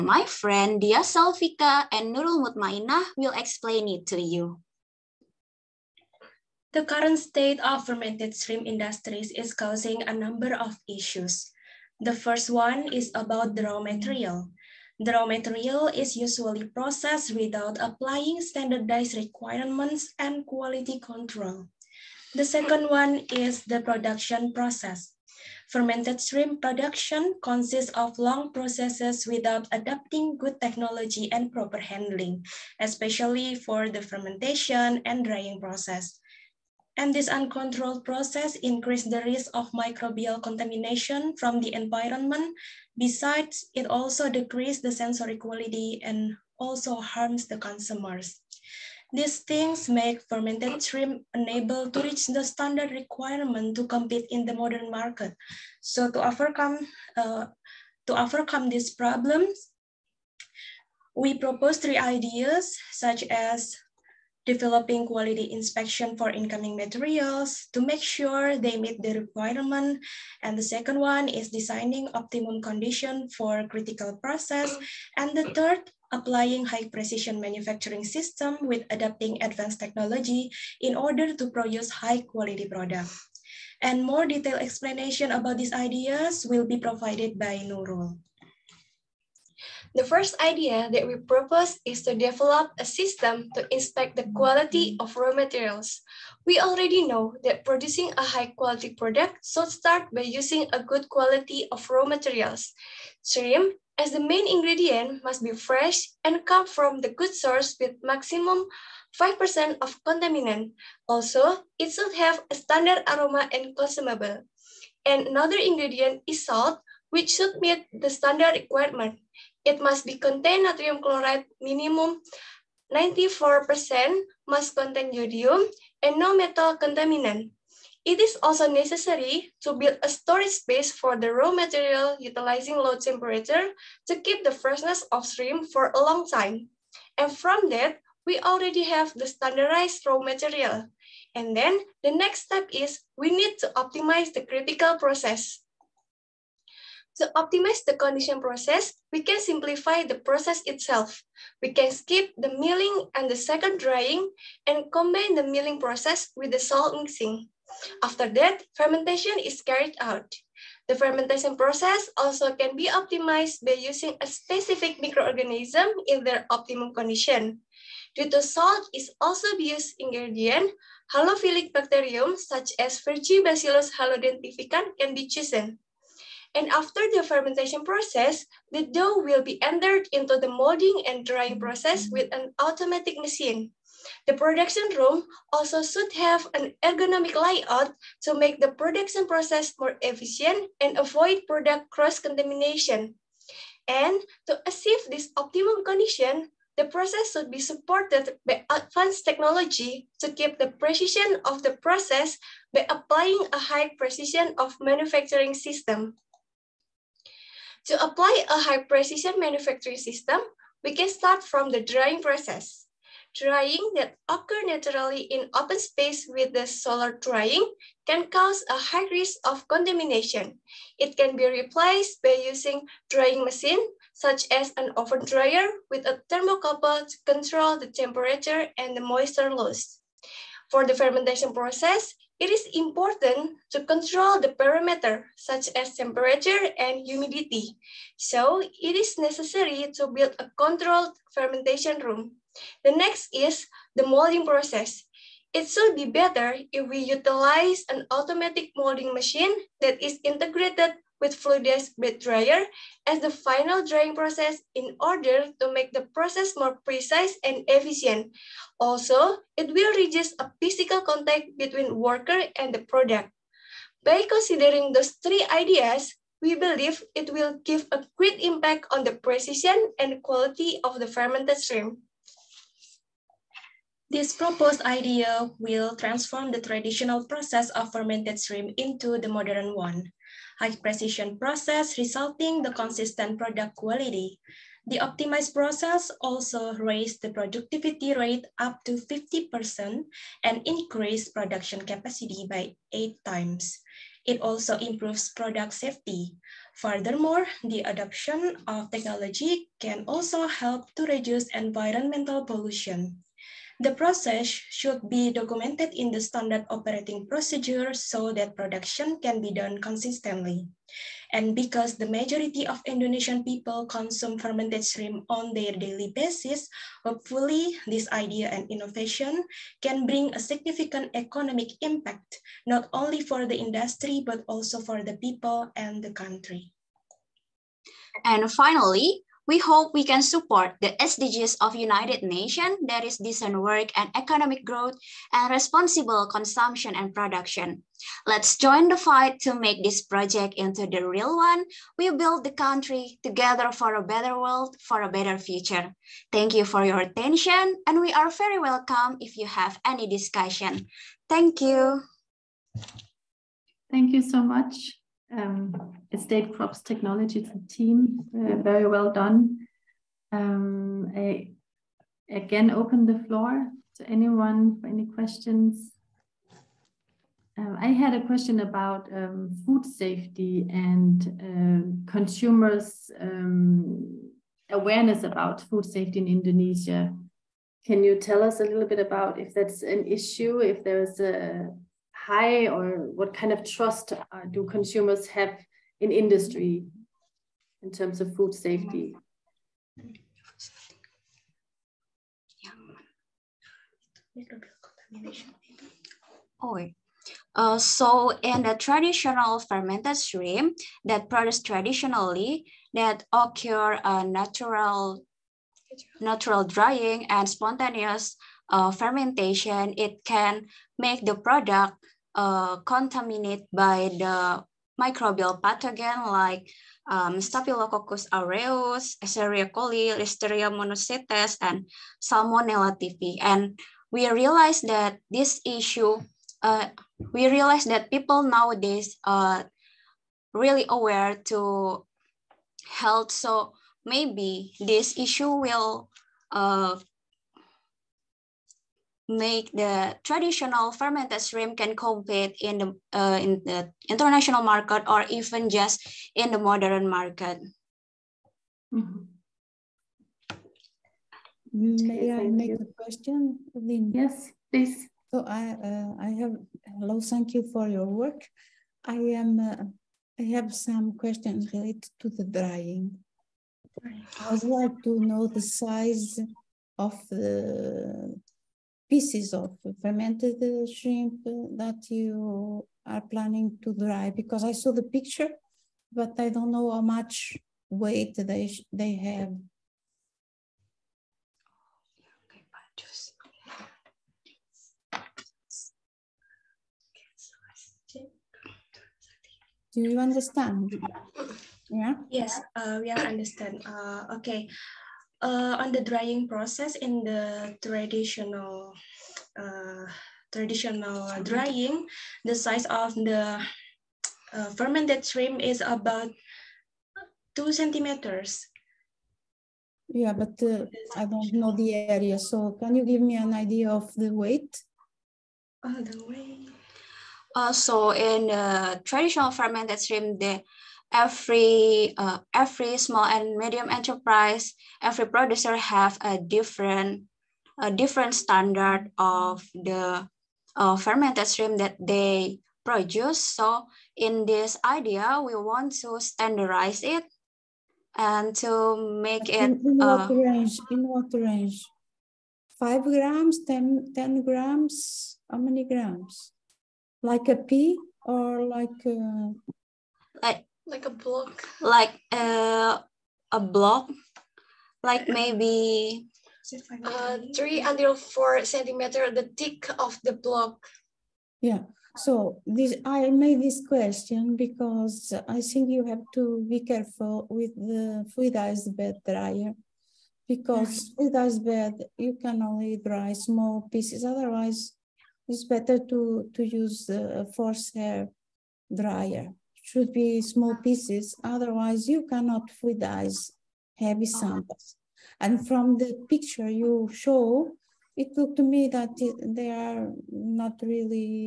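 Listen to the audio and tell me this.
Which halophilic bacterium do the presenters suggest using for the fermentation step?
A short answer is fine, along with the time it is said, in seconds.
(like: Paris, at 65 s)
Bacillus halodenitrificans, at 173 s.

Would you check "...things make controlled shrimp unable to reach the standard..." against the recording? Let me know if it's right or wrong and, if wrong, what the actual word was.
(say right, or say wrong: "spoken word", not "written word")
wrong: "fermented", not "controlled".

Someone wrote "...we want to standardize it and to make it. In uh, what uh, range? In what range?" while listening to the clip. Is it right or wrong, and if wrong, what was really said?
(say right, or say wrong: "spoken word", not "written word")
right.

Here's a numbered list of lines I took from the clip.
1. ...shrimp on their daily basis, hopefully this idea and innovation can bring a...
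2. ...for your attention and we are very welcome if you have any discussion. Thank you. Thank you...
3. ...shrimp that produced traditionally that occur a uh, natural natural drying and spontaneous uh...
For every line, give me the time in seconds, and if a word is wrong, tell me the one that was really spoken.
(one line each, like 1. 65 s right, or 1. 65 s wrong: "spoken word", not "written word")
1. 314 s right
2. 346 s right
3. 400 s right.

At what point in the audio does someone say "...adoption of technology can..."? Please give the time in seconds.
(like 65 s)
297 s.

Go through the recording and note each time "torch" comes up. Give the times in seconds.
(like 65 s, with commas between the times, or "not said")
not said.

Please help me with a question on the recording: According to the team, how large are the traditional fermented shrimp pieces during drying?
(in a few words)
2 centimeters.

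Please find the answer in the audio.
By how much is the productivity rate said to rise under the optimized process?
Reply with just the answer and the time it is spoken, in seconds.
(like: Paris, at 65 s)
up to 50%, at 288 s.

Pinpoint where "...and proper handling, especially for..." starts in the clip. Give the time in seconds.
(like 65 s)
31 s.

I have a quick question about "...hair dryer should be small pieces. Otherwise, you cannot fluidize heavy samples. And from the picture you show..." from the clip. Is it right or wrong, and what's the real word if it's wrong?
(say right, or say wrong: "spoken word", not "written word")
right.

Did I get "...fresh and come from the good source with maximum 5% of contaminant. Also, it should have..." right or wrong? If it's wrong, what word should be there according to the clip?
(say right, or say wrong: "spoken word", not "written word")
right.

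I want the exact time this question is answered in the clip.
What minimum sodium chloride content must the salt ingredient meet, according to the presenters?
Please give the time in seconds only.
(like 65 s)
121 s.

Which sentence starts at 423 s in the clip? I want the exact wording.
And we realized that this issue, uh, we realized that people nowadays are really aware to health.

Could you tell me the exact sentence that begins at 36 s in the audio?
And this uncontrolled process increases the risk of microbial contamination from the environment.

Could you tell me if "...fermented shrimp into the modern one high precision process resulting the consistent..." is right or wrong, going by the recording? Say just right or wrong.
right.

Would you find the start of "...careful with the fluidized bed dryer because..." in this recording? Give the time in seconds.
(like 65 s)
566 s.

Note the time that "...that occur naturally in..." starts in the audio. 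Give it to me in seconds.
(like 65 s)
213 s.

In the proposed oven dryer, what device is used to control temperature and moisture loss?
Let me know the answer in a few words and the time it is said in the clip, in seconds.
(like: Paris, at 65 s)
thermocouple, at 226 s.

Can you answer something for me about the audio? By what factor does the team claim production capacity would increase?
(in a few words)
8 times.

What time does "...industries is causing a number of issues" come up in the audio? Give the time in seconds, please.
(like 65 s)
8 s.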